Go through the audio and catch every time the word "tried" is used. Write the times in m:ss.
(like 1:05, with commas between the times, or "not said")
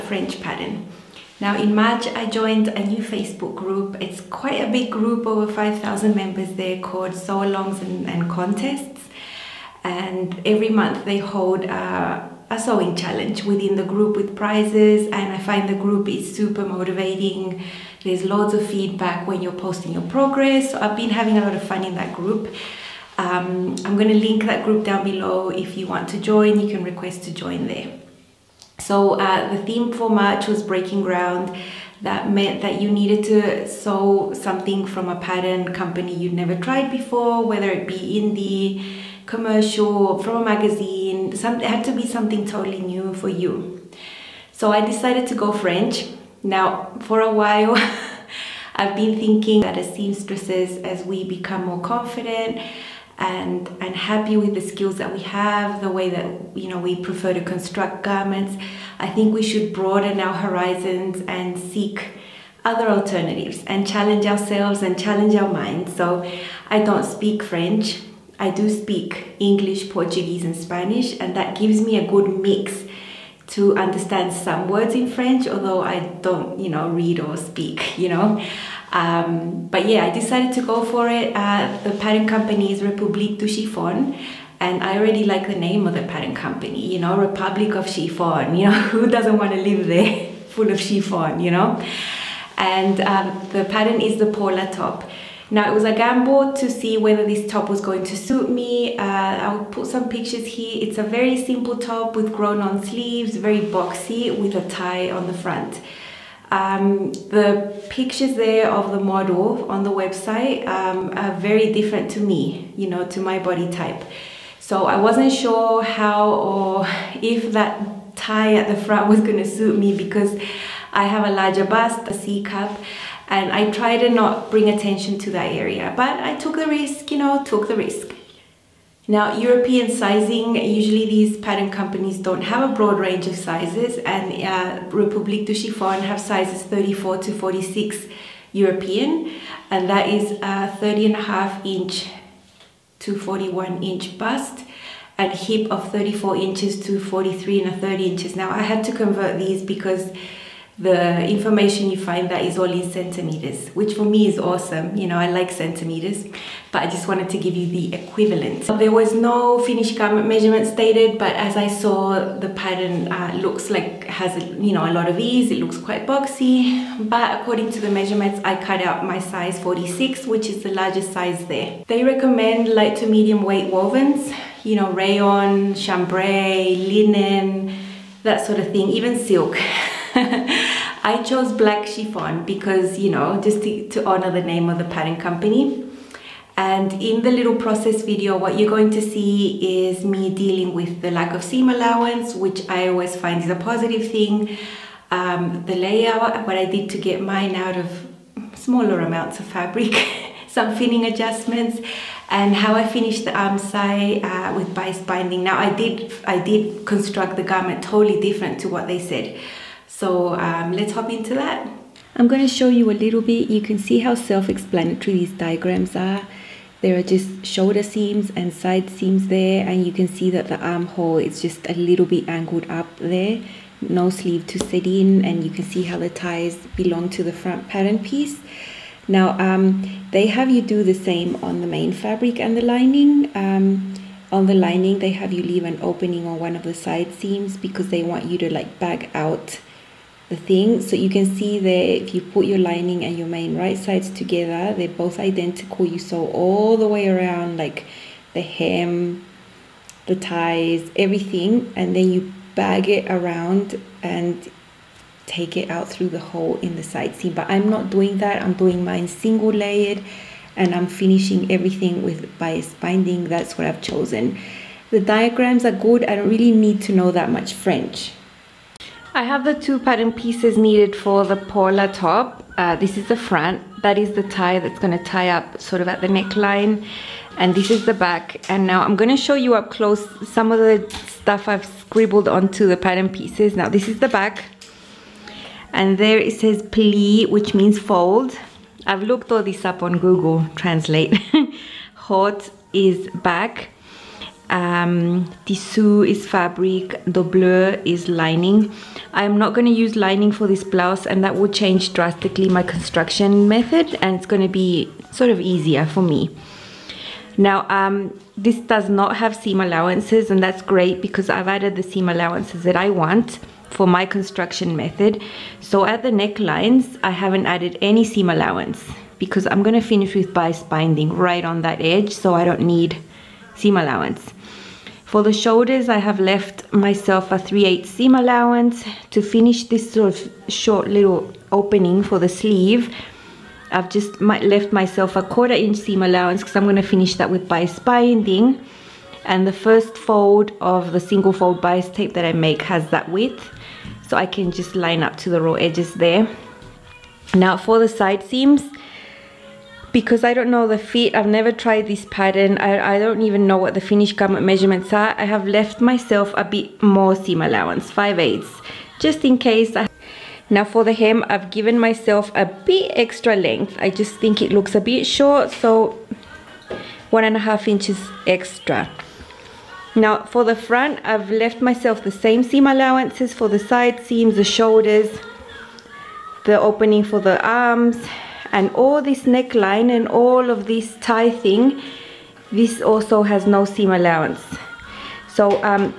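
0:36, 5:51.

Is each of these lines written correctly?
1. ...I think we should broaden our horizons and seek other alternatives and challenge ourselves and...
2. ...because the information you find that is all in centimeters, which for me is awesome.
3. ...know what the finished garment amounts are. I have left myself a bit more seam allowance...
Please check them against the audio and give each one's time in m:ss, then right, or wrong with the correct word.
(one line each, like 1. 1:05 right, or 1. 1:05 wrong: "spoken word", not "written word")
1. 0:58 right
2. 2:29 right
3. 5:53 wrong: "measurements", not "amounts".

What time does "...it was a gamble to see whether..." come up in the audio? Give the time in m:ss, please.
1:35.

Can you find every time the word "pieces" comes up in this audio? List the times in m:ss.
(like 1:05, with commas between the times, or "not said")
3:47, 4:30, 4:43.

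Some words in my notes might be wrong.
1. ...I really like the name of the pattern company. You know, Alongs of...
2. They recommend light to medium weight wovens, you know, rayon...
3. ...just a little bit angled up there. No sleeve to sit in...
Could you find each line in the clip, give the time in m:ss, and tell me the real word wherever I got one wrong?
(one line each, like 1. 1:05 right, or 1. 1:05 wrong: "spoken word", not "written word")
1. 1:24 wrong: "Republic", not "Alongs"
2. 2:51 right
3. 3:41 right.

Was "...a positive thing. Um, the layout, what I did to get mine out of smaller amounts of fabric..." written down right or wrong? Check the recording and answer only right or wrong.
right.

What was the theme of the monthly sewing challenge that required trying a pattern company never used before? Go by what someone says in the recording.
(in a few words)
breaking ground.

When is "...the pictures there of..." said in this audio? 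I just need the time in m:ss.
1:47.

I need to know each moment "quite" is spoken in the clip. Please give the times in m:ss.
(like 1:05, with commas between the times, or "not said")
0:04, 2:45.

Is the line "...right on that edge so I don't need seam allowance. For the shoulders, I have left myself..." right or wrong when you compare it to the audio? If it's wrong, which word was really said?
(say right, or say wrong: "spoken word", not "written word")
right.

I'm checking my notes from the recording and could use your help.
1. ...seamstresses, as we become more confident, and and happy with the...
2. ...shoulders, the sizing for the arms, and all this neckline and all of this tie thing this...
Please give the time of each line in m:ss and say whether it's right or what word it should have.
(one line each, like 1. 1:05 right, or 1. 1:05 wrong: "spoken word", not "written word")
1. 0:49 right
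2. 6:14 wrong: "opening", not "sizing".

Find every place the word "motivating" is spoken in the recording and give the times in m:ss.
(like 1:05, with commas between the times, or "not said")
0:16.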